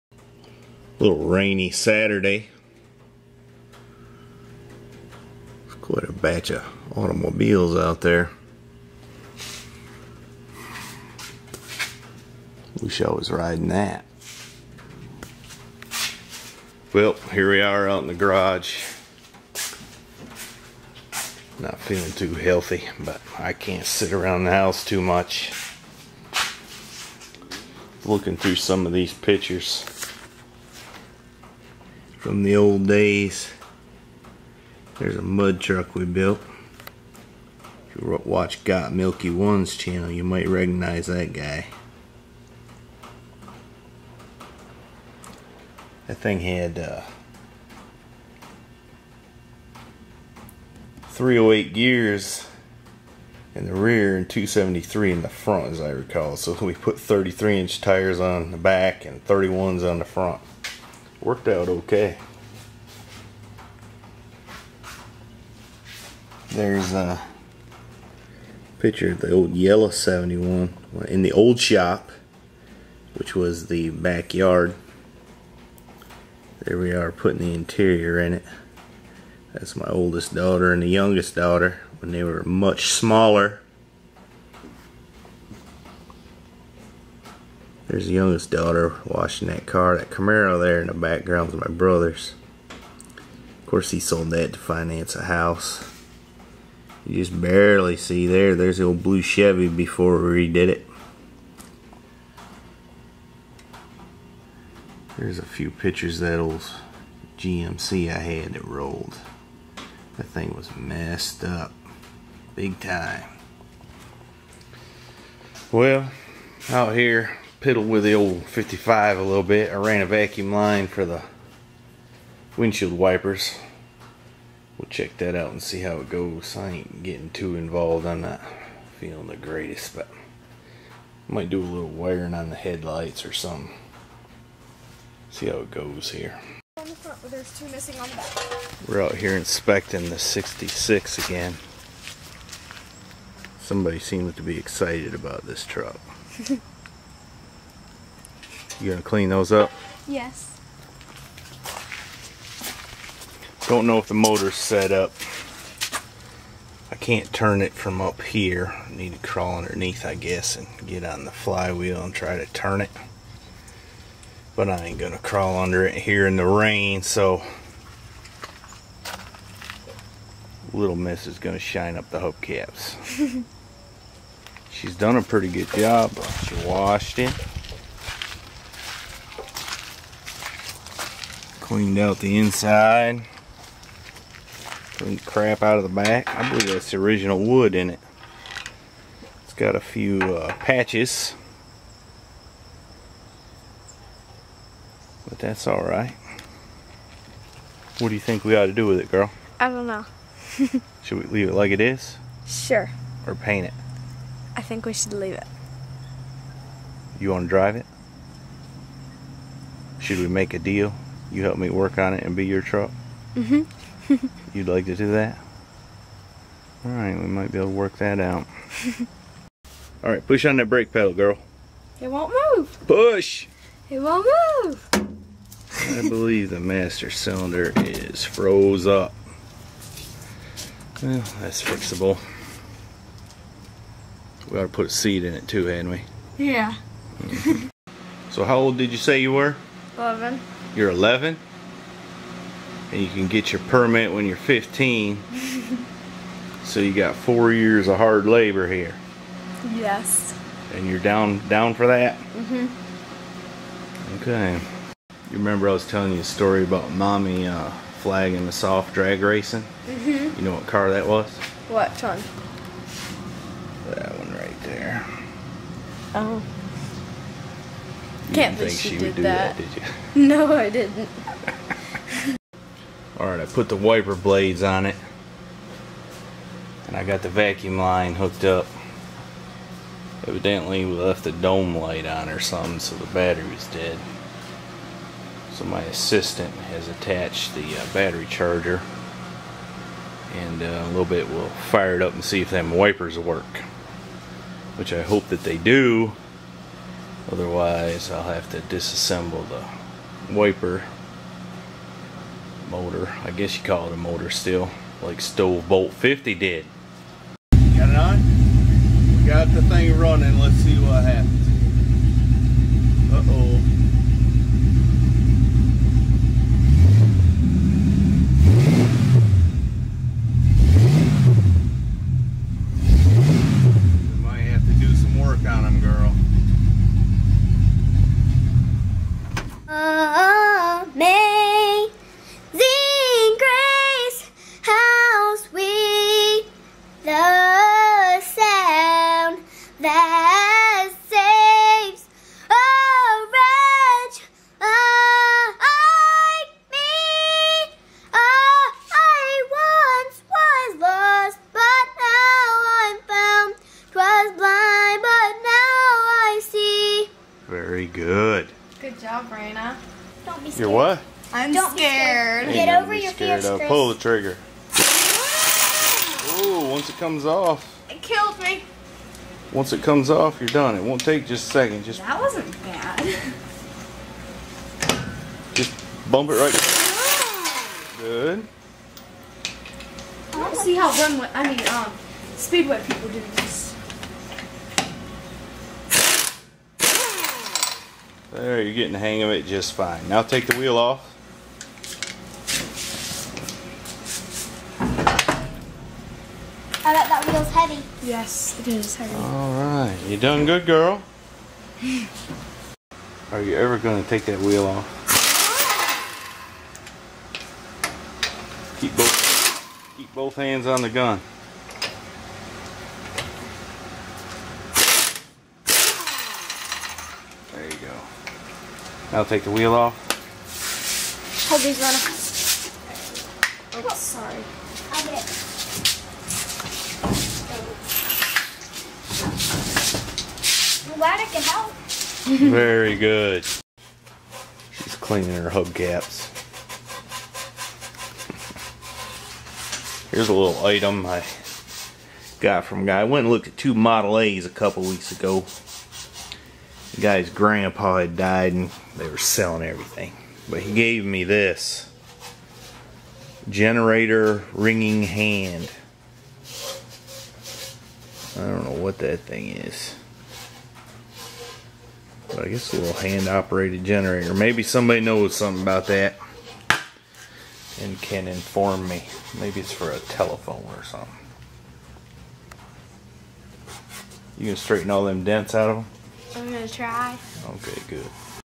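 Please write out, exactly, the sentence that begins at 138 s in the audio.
We're out here inspecting the 66 again.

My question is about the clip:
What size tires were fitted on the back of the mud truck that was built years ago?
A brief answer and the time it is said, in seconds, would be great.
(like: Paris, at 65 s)
33 inch, at 56 s.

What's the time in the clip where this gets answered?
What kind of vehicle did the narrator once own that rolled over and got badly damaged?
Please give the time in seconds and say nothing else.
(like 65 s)
107 s.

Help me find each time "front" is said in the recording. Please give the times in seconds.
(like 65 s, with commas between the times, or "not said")
55 s, 60 s.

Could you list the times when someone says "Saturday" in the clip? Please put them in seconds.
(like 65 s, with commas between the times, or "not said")
1 s.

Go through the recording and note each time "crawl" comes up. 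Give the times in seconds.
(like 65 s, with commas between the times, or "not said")
159 s, 165 s.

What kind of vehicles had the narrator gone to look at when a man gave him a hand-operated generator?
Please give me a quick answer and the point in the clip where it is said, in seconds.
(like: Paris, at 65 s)
Model A's, at 443 s.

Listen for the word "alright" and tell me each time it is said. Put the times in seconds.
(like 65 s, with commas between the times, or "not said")
195 s, 399 s.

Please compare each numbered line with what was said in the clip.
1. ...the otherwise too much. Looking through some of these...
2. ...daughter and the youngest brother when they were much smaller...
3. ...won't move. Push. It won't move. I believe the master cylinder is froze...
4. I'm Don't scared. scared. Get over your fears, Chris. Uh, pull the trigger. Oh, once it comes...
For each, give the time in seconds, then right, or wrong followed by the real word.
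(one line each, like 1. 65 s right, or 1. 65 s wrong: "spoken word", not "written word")
1. 24 s wrong: "house", not "otherwise"
2. 80 s wrong: "daughter", not "brother"
3. 222 s right
4. 361 s right.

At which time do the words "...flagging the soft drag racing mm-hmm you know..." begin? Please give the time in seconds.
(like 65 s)
258 s.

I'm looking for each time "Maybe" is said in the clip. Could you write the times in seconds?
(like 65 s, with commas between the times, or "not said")
464 s, 469 s.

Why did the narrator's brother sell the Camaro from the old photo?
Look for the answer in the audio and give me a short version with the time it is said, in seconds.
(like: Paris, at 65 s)
To finance a house, at 94 s.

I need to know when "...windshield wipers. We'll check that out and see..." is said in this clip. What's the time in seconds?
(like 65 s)
122 s.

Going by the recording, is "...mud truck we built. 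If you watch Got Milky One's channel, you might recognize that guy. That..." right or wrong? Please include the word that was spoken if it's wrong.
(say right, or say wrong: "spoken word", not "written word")
right.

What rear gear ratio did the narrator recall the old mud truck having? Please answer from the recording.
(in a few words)
308.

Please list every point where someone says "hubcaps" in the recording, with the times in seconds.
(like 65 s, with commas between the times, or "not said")
172 s, 435 s.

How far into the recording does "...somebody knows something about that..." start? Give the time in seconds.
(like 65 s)
464 s.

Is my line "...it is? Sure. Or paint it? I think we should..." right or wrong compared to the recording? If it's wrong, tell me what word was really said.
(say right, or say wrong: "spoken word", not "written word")
right.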